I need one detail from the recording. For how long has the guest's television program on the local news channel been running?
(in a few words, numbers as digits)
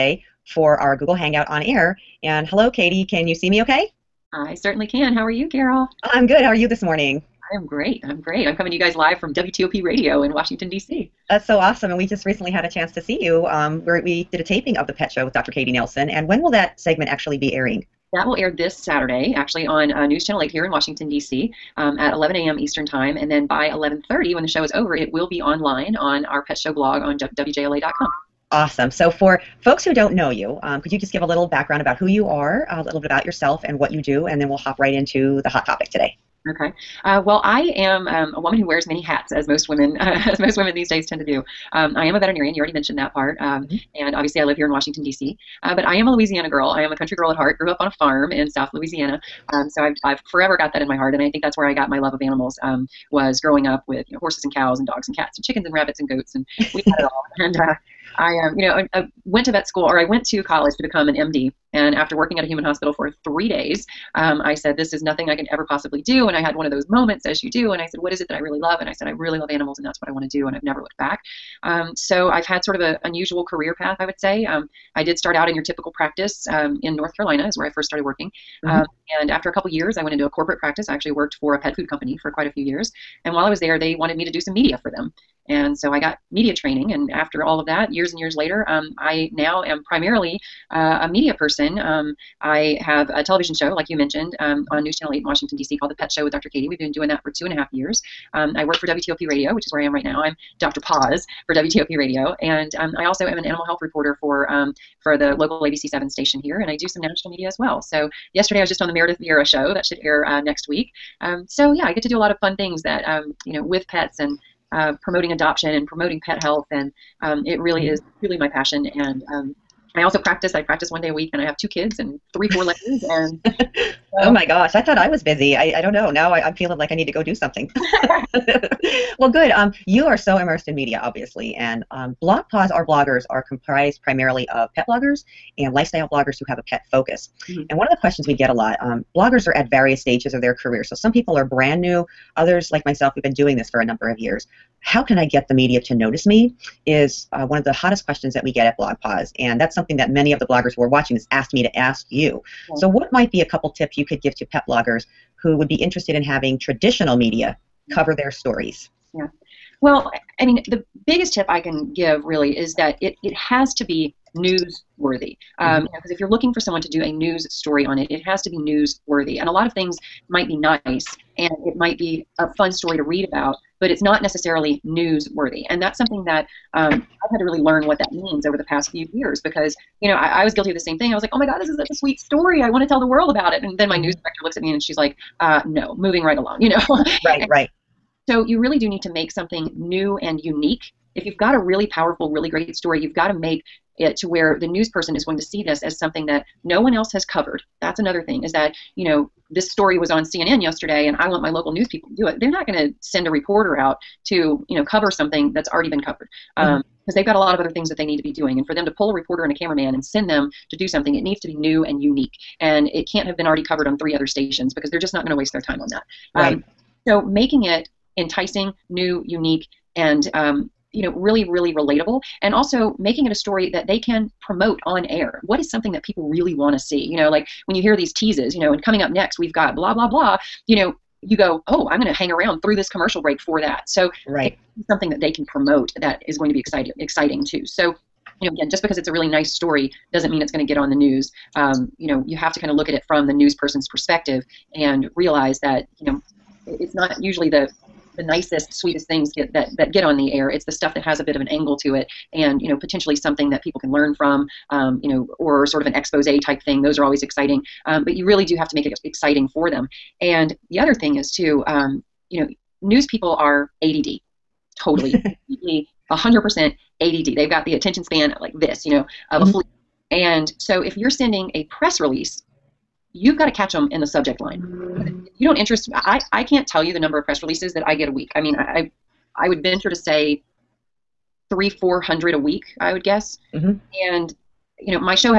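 2.5 years.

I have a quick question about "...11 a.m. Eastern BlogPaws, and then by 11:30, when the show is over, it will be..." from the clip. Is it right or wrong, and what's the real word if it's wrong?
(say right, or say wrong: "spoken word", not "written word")
wrong: "Time", not "BlogPaws".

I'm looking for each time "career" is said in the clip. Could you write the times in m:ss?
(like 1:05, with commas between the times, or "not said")
1:13, 2:20.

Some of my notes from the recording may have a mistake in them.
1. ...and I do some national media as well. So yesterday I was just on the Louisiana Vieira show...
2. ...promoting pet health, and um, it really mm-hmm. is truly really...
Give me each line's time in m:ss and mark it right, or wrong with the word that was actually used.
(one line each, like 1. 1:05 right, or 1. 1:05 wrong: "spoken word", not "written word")
1. 1:46 wrong: "Meredith", not "Louisiana"
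2. 1:55 right.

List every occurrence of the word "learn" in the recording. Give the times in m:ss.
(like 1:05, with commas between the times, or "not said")
2:57, 4:13.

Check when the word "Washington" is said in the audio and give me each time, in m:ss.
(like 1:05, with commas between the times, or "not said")
0:10, 0:20, 0:44, 1:35.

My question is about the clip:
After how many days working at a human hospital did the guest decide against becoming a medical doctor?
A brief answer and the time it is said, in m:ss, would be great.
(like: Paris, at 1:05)
3, at 1:03.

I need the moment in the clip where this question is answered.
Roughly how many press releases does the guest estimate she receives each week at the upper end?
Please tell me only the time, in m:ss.
4:41.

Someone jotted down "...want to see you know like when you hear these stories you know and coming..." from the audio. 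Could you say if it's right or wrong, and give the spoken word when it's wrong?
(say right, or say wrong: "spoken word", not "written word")
wrong: "teases", not "stories".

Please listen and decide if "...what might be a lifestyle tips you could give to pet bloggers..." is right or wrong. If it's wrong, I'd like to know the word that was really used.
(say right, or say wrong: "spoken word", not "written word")
wrong: "couple", not "lifestyle".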